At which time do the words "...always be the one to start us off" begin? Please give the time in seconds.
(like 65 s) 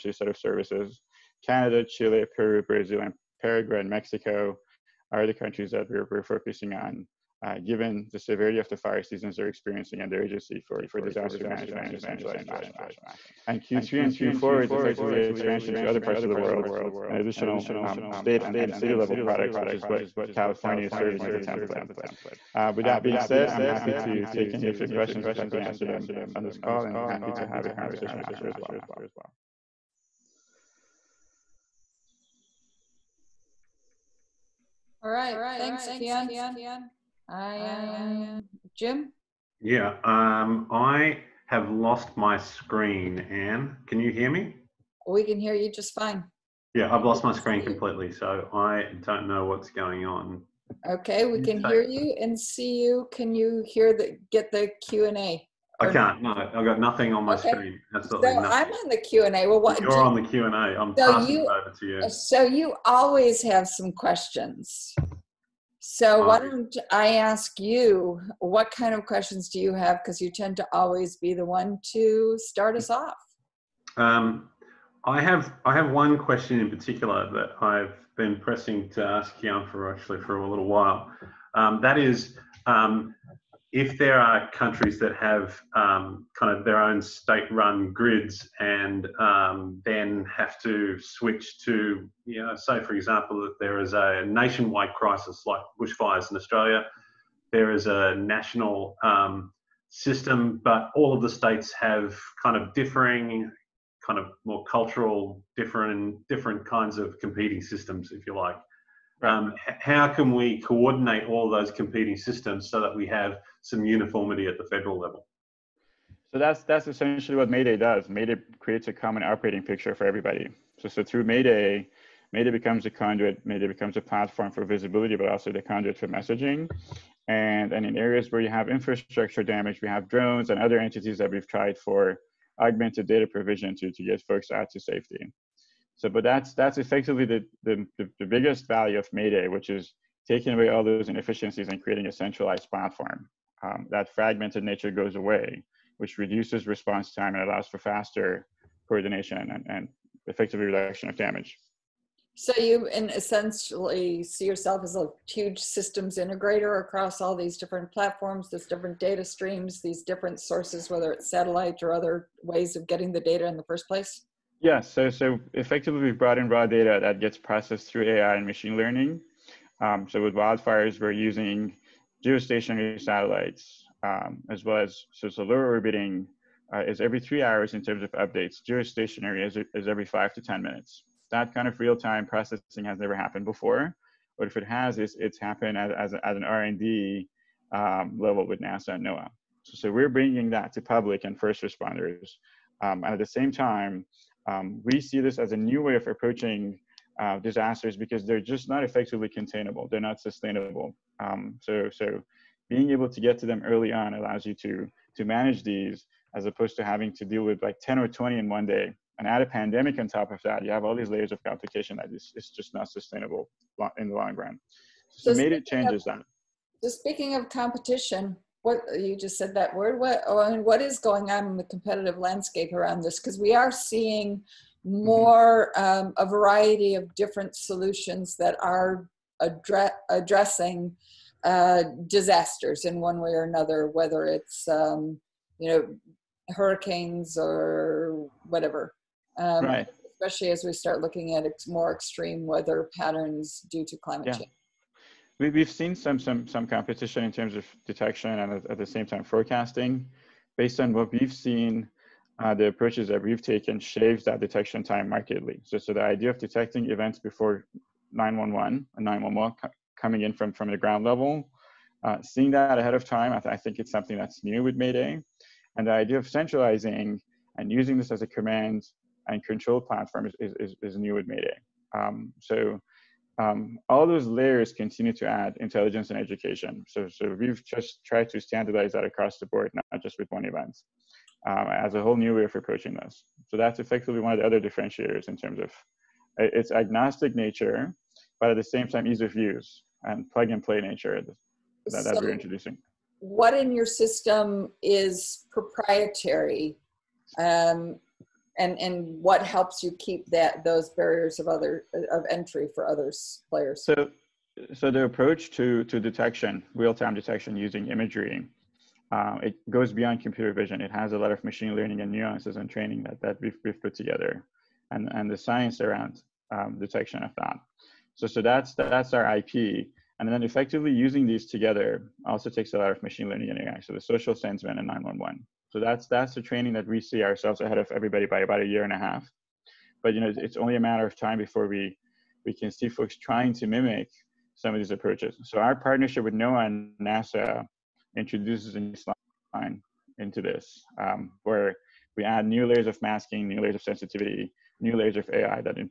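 70 s.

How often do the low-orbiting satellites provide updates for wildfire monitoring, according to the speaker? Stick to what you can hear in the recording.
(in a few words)
every 3 hours.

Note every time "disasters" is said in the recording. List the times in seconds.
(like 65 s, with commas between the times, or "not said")
11 s, 197 s, 232 s.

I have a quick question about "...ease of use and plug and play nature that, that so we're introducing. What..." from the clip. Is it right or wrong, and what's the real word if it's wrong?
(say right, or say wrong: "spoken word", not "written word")
right.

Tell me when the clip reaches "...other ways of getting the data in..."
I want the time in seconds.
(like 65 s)
161 s.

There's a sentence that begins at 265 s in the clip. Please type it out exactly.
And the idea of centralizing and using this as a command and control platform is, is, is new with Mayday.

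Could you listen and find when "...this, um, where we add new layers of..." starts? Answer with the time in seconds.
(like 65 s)
340 s.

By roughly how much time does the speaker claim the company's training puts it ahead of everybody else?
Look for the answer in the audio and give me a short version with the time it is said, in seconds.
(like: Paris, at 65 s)
a year and a half, at 328 s.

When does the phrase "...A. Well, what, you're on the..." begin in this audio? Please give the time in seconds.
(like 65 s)
59 s.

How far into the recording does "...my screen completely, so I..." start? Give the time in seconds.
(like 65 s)
47 s.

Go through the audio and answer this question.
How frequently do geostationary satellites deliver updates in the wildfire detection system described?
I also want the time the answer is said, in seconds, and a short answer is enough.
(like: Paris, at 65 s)
every 5 to 10 minutes, at 179 s.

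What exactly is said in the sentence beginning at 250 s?
Based on what we've seen, uh, the approaches that we've taken shaves that detection time markedly.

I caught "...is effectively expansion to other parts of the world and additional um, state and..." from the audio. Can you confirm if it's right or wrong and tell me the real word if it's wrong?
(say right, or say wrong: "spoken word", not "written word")
right.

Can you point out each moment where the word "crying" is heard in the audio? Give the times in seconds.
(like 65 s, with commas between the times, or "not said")
not said.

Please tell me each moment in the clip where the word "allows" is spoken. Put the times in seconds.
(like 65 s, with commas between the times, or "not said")
147 s, 204 s.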